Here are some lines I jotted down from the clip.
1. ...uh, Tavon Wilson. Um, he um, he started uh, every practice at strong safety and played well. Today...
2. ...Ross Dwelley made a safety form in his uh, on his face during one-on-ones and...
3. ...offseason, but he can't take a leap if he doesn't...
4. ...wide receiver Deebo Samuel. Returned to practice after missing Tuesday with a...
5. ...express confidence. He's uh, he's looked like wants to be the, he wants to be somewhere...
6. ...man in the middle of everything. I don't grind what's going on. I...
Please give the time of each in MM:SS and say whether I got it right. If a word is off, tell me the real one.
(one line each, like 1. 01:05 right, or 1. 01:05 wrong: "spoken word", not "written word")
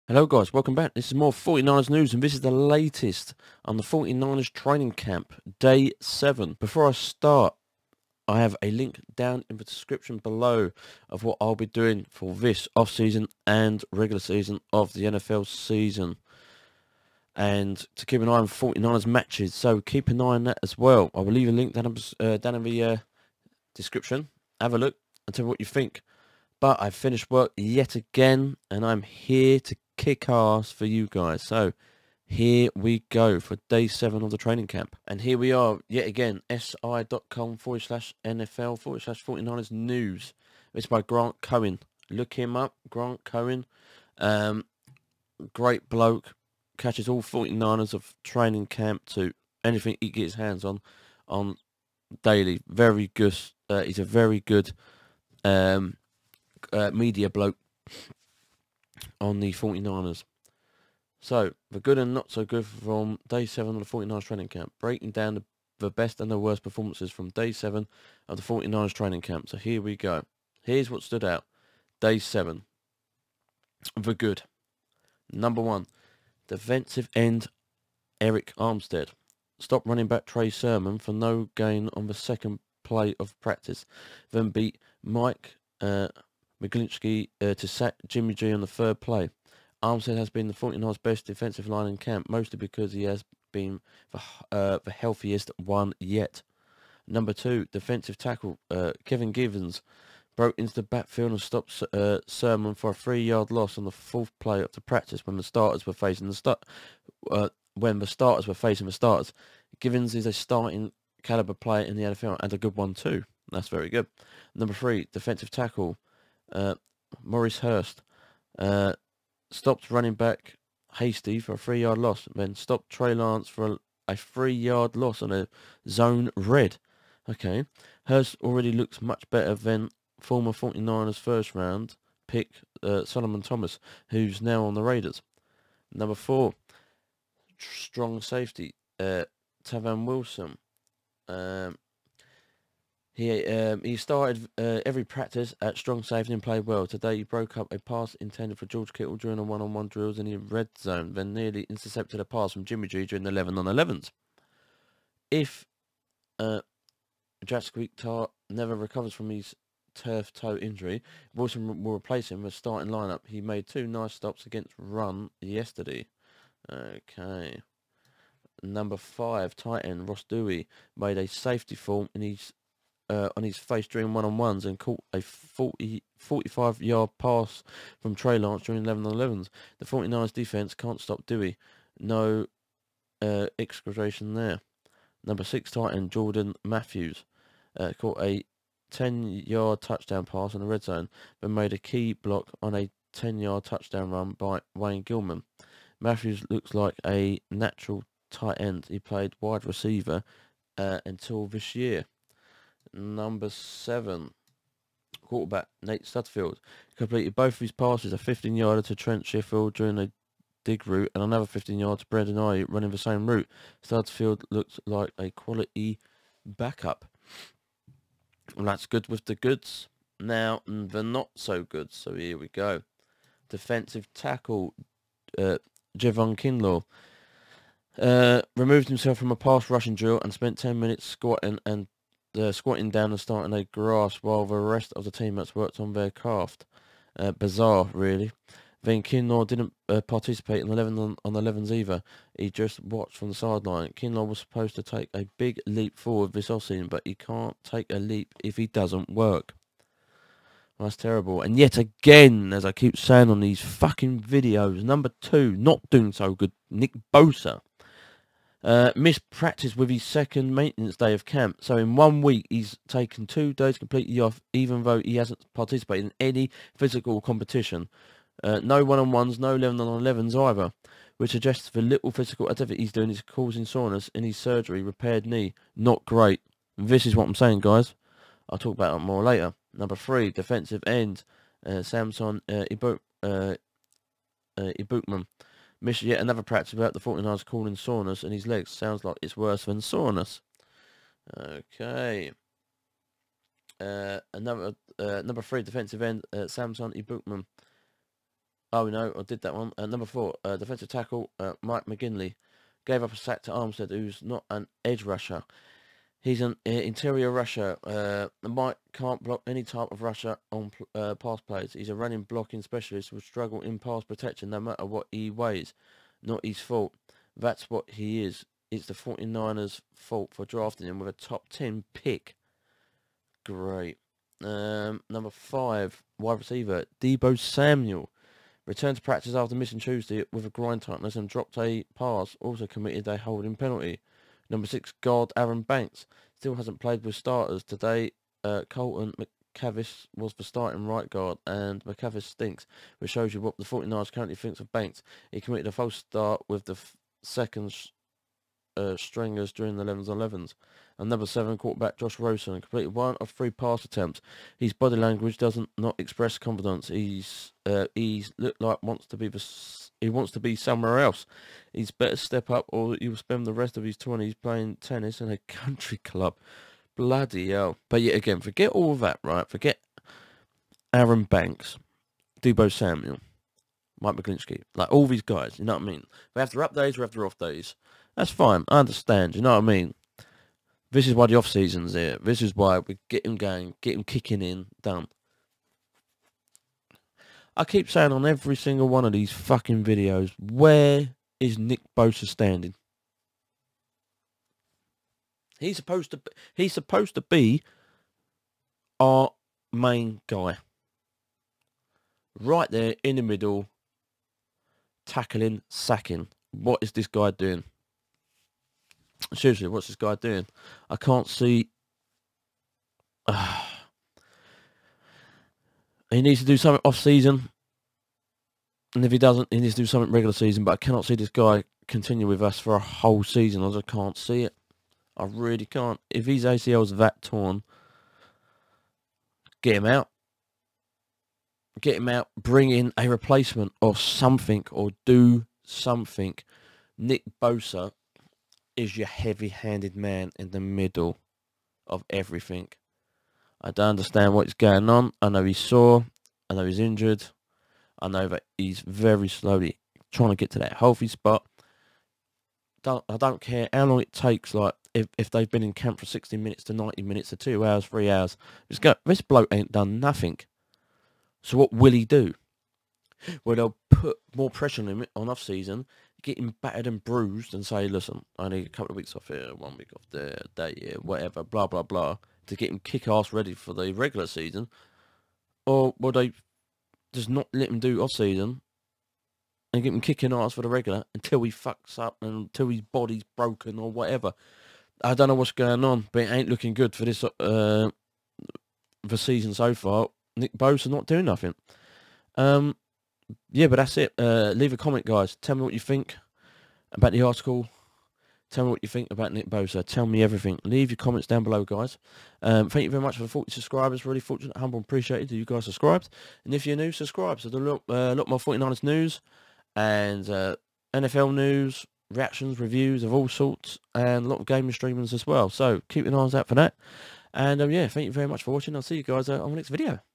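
1. 02:18 right
2. 02:50 right
3. 04:06 right
4. 05:26 right
5. 05:55 right
6. 07:19 wrong: "understand", not "grind".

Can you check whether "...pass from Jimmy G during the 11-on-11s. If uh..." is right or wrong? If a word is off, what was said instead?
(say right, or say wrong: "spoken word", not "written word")
right.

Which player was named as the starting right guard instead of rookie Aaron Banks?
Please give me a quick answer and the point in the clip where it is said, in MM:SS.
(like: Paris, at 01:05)
Colton McKivitz, at 05:38.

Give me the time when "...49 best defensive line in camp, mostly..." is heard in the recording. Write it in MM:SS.
01:30.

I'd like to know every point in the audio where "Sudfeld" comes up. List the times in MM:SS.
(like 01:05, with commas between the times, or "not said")
03:26, 03:33.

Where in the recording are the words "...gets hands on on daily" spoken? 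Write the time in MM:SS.
00:50.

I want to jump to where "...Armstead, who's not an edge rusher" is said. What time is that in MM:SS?
05:03.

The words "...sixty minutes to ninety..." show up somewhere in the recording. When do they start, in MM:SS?
07:36.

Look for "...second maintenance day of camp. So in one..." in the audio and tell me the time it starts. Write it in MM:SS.
04:20.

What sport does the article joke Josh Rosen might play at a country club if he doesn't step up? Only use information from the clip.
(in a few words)
tennis.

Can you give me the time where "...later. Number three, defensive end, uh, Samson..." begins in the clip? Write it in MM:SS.
04:39.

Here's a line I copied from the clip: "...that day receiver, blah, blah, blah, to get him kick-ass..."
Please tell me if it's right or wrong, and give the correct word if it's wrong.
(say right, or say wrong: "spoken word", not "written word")
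wrong: "whatever", not "receiver".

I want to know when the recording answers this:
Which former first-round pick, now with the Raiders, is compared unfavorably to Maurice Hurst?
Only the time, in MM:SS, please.
02:13.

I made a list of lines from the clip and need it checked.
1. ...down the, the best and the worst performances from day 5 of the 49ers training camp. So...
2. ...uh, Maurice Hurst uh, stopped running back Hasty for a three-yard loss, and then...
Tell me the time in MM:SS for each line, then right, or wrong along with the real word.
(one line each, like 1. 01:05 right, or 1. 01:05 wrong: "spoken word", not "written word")
1. 01:05 wrong: "7", not "5"
2. 01:56 right.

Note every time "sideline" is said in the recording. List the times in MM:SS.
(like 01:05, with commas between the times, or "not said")
04:03.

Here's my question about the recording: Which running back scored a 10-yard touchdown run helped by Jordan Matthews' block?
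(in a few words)
Wayne Gallman.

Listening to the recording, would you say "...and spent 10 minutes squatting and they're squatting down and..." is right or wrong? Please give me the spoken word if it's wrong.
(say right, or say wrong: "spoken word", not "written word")
right.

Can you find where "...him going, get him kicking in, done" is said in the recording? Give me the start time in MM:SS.
06:23.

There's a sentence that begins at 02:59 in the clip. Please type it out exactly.
The 49ers defense can't stop Dwelley.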